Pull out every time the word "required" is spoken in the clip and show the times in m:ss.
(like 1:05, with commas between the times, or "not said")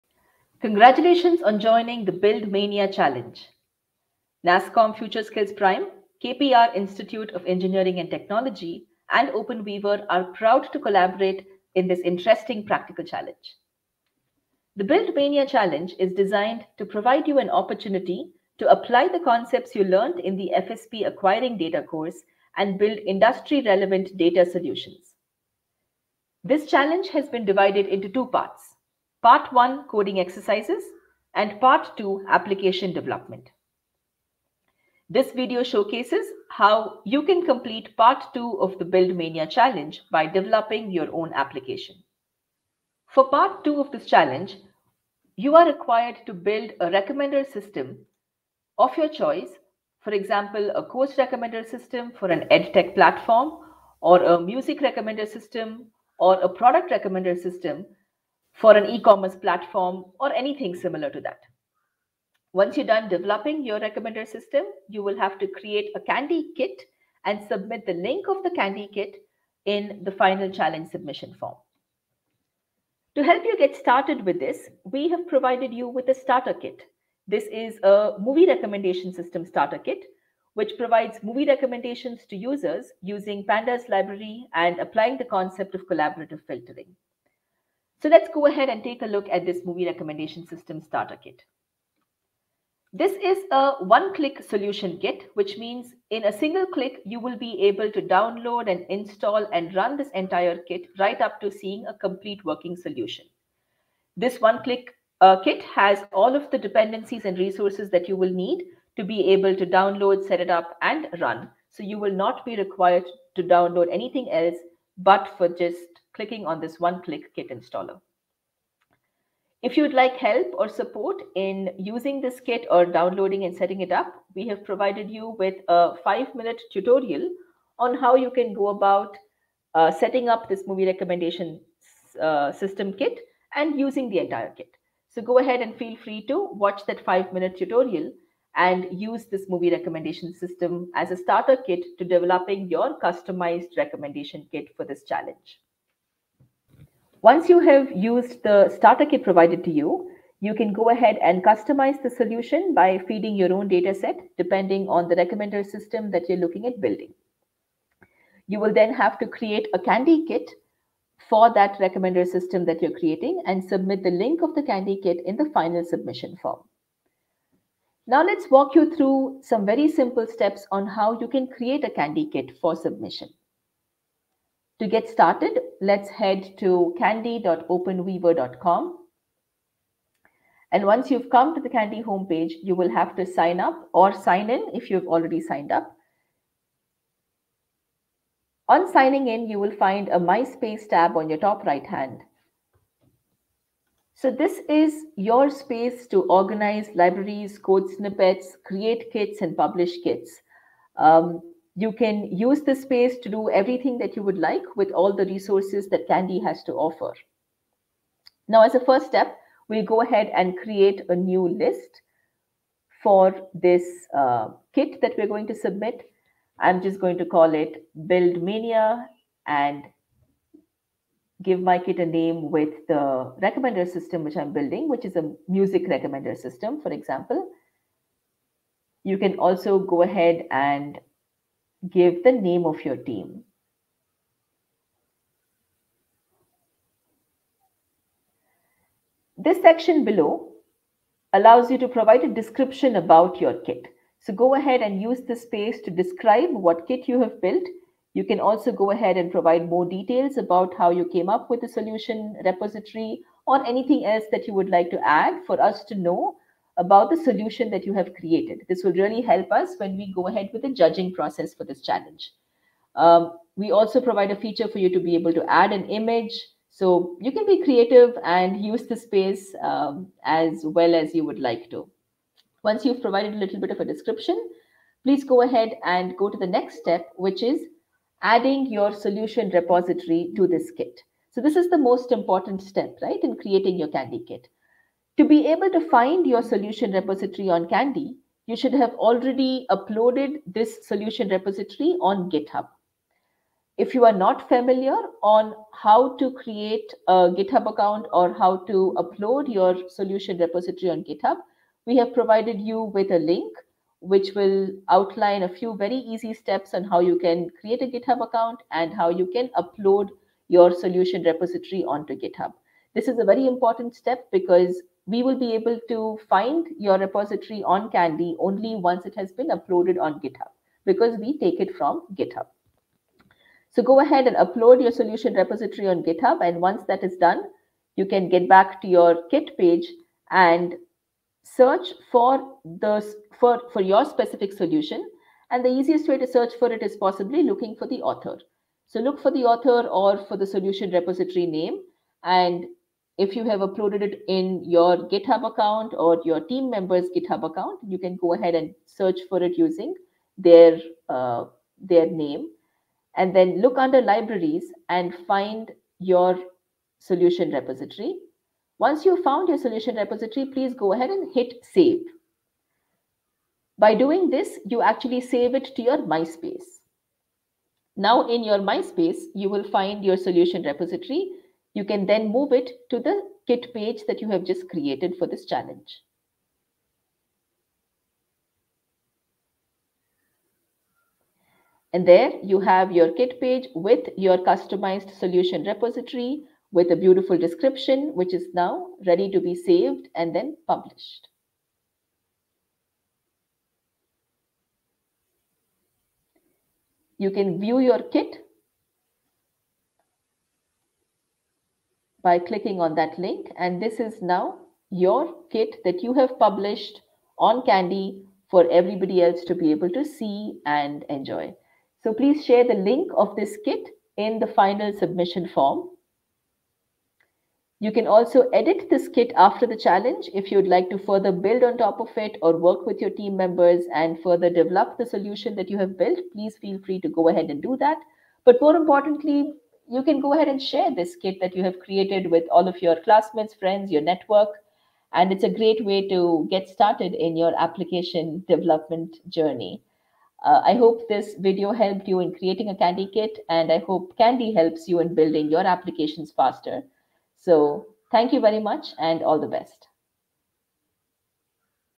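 0:45, 1:52.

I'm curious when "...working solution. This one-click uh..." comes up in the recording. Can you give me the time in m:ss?
1:42.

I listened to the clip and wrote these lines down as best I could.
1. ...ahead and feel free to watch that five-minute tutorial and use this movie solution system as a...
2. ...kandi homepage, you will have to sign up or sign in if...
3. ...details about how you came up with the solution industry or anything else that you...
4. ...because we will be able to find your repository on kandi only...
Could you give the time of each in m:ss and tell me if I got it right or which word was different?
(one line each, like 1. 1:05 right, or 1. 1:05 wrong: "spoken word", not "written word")
1. 2:15 wrong: "recommendation", not "solution"
2. 3:01 right
3. 4:09 wrong: "repository", not "industry"
4. 5:14 right.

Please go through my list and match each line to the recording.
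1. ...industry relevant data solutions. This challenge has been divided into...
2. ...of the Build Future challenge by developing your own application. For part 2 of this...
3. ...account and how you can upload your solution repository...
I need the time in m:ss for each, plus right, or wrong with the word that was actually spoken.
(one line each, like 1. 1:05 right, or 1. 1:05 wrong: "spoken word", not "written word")
1. 0:22 right
2. 0:38 wrong: "Mania", not "Future"
3. 5:08 right.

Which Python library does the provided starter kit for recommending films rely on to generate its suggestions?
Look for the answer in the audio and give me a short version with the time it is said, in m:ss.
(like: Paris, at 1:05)
Pandas, at 1:23.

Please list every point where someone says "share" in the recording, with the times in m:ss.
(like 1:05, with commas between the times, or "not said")
6:52, 7:10.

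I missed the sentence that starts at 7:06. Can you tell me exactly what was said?
Please feel free to go ahead and do that.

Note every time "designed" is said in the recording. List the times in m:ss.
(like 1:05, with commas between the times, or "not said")
0:16.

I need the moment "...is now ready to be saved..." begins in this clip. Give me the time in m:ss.
6:28.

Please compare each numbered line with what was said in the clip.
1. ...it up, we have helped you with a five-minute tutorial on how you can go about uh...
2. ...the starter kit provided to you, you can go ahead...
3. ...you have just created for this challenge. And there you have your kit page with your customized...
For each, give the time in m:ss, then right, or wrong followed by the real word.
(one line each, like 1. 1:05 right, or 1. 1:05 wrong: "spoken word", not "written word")
1. 2:03 wrong: "provided", not "helped"
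2. 2:28 right
3. 6:14 right.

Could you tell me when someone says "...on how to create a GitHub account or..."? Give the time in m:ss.
4:55.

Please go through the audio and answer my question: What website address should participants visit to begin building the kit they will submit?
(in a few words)
kandi.openweaver.com.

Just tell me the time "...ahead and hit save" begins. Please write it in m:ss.
6:00.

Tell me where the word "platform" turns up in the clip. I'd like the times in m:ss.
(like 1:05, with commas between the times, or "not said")
0:52, 0:59.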